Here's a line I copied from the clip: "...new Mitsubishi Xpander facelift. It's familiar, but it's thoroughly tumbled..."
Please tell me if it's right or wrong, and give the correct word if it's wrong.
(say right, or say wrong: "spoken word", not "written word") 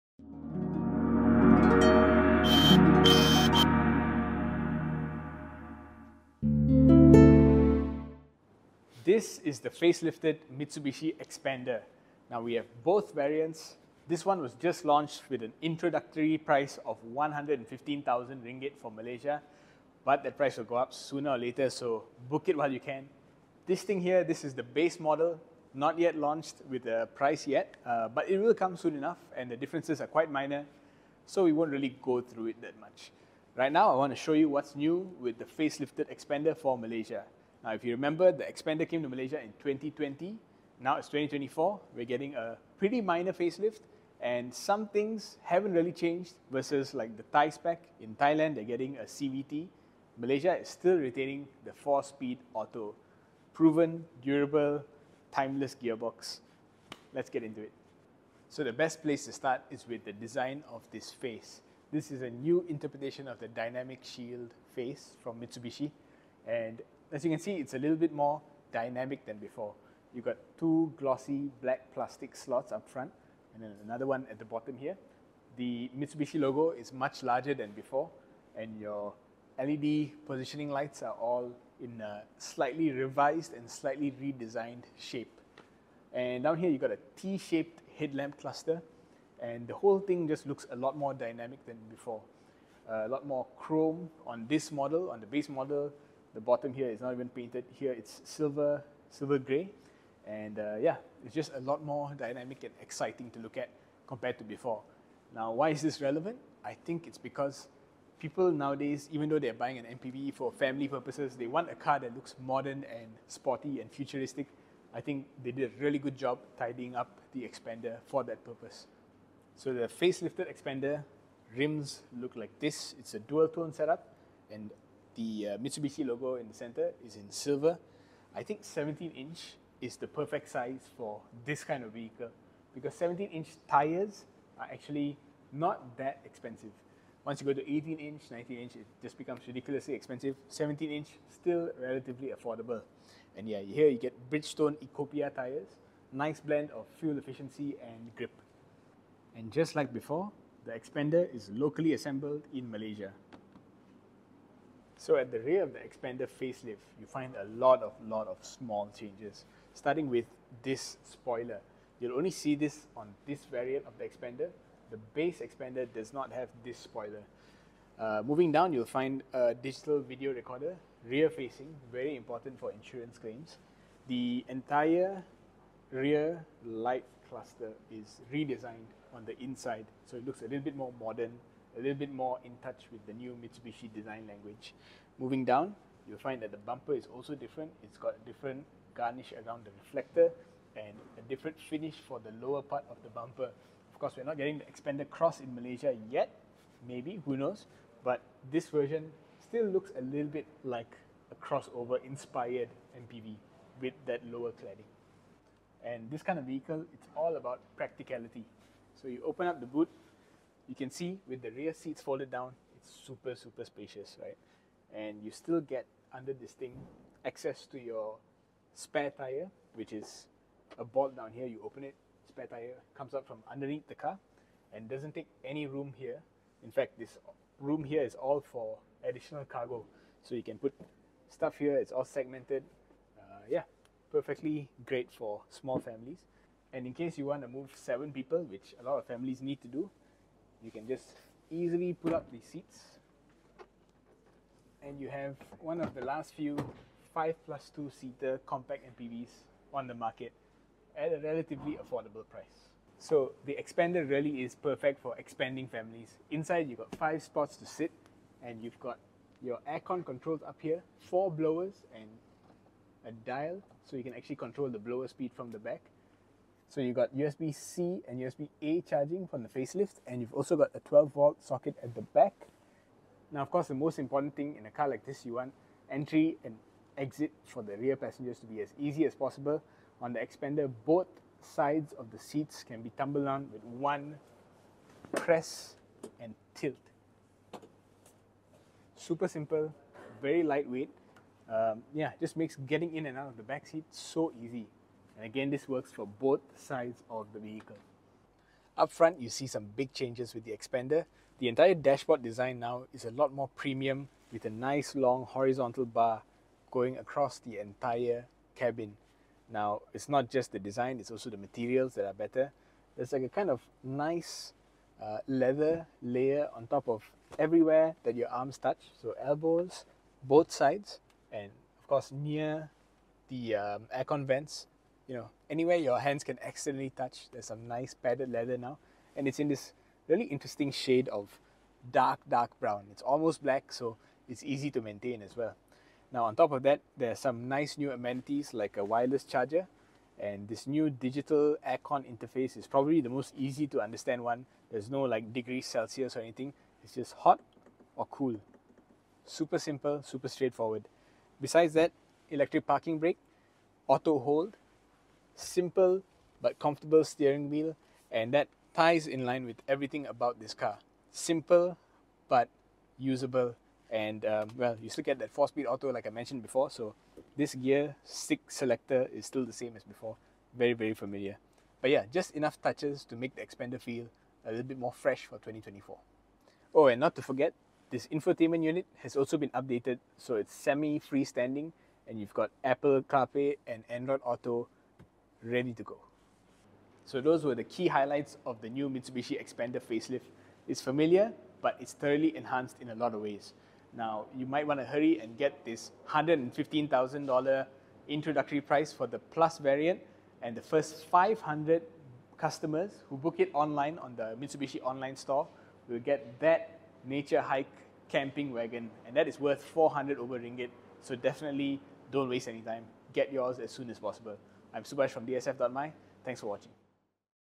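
wrong: "enhanced", not "tumbled".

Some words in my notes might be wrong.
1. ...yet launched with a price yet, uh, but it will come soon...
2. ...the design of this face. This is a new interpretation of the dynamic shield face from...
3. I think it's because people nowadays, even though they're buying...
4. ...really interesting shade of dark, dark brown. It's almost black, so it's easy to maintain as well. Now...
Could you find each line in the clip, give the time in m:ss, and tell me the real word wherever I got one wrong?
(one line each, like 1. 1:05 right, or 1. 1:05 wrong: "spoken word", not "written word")
1. 0:25 right
2. 1:00 right
3. 1:46 right
4. 5:30 right.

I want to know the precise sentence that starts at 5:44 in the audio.
There's no like degrees Celsius or anything.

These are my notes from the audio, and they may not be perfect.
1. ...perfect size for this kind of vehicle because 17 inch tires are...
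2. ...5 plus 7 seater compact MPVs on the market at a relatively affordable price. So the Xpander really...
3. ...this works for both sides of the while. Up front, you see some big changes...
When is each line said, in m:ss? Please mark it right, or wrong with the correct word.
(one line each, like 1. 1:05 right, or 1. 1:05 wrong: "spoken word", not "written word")
1. 2:10 right
2. 4:07 wrong: "2", not "7"
3. 4:55 wrong: "vehicle", not "while".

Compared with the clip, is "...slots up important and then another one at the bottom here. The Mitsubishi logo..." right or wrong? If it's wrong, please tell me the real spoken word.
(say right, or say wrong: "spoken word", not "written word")
wrong: "front", not "important".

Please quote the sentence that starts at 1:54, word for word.
I think they did a really good job tidying up the Xpander for that purpose.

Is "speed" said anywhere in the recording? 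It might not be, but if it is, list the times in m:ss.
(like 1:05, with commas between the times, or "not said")
0:52, 4:25, 6:05.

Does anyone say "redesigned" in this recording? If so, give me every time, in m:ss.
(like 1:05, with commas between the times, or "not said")
1:24, 2:58.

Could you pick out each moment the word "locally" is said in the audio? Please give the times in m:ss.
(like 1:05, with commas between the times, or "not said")
2:31.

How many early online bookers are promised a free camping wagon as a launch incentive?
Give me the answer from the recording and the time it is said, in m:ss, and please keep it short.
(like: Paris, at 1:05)
500, at 6:41.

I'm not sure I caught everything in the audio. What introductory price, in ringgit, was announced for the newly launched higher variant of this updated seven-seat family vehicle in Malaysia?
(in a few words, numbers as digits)
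115,000 ringgit.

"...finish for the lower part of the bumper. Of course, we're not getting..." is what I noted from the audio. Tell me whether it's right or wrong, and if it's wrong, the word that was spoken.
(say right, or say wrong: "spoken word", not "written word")
right.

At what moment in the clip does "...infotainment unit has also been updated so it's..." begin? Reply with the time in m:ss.
6:18.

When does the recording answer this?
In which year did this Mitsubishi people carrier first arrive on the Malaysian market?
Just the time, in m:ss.
0:39.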